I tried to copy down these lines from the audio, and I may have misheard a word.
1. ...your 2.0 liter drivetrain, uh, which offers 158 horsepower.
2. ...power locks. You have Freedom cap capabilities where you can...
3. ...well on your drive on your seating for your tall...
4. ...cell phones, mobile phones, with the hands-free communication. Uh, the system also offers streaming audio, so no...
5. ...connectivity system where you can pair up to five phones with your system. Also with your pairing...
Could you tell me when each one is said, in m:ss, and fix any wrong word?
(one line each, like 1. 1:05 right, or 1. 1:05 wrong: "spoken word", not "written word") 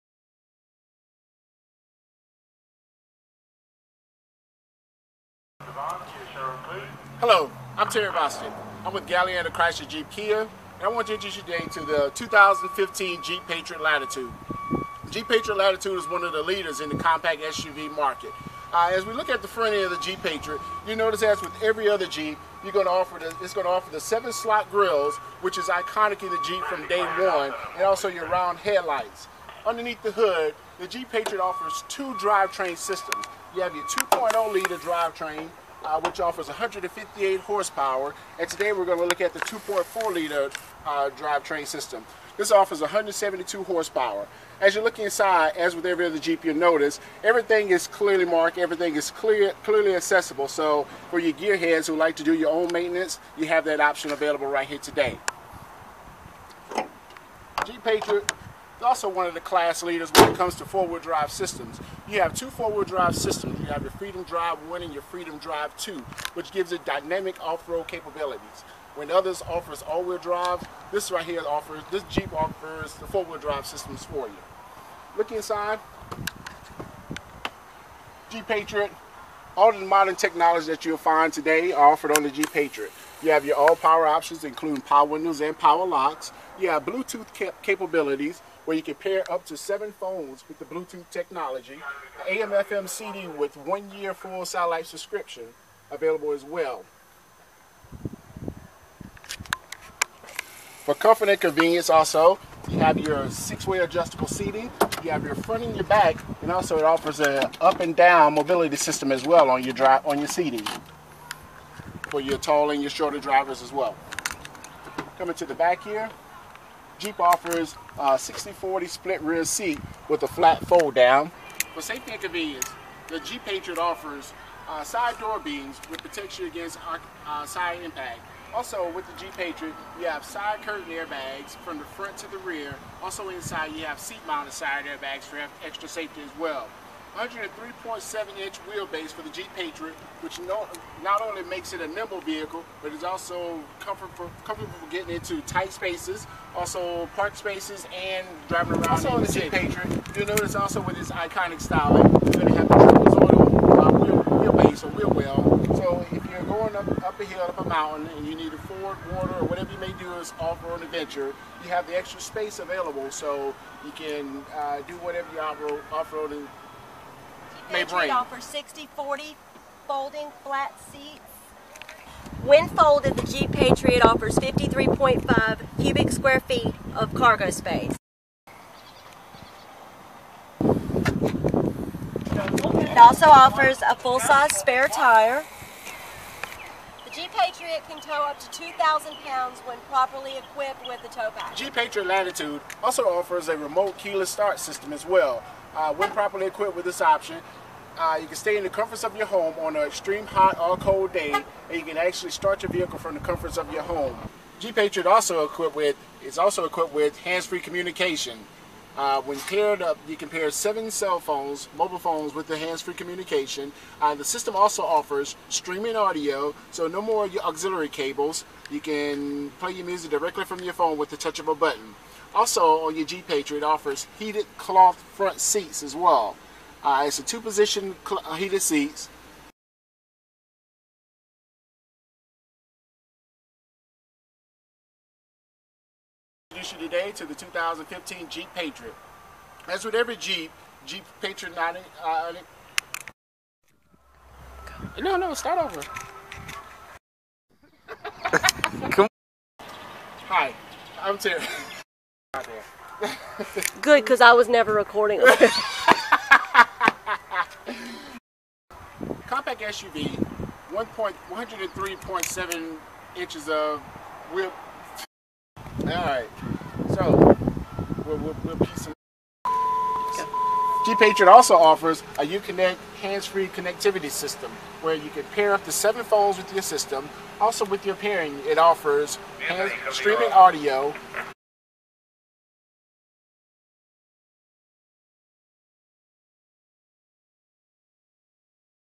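1. 0:33 right
2. 1:25 wrong: "Bluetooth", not "Freedom"
3. 1:49 right
4. 3:30 right
5. 4:33 wrong: "seven", not "five".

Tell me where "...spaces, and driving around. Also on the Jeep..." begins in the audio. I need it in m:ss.
2:27.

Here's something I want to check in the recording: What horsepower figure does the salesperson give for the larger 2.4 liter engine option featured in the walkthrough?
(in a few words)
172.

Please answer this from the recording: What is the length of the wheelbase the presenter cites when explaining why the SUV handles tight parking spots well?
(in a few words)
103.7 inches.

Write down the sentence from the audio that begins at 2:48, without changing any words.
offers 60, 40 folding flat seats.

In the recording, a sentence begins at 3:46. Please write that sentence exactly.
Uh, it's a two position uh, heated seats.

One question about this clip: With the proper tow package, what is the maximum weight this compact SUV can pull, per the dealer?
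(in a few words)
2,000 pounds.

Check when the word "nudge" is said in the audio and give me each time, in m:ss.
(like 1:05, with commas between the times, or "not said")
not said.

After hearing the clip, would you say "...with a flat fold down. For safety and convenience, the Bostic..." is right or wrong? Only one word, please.
wrong.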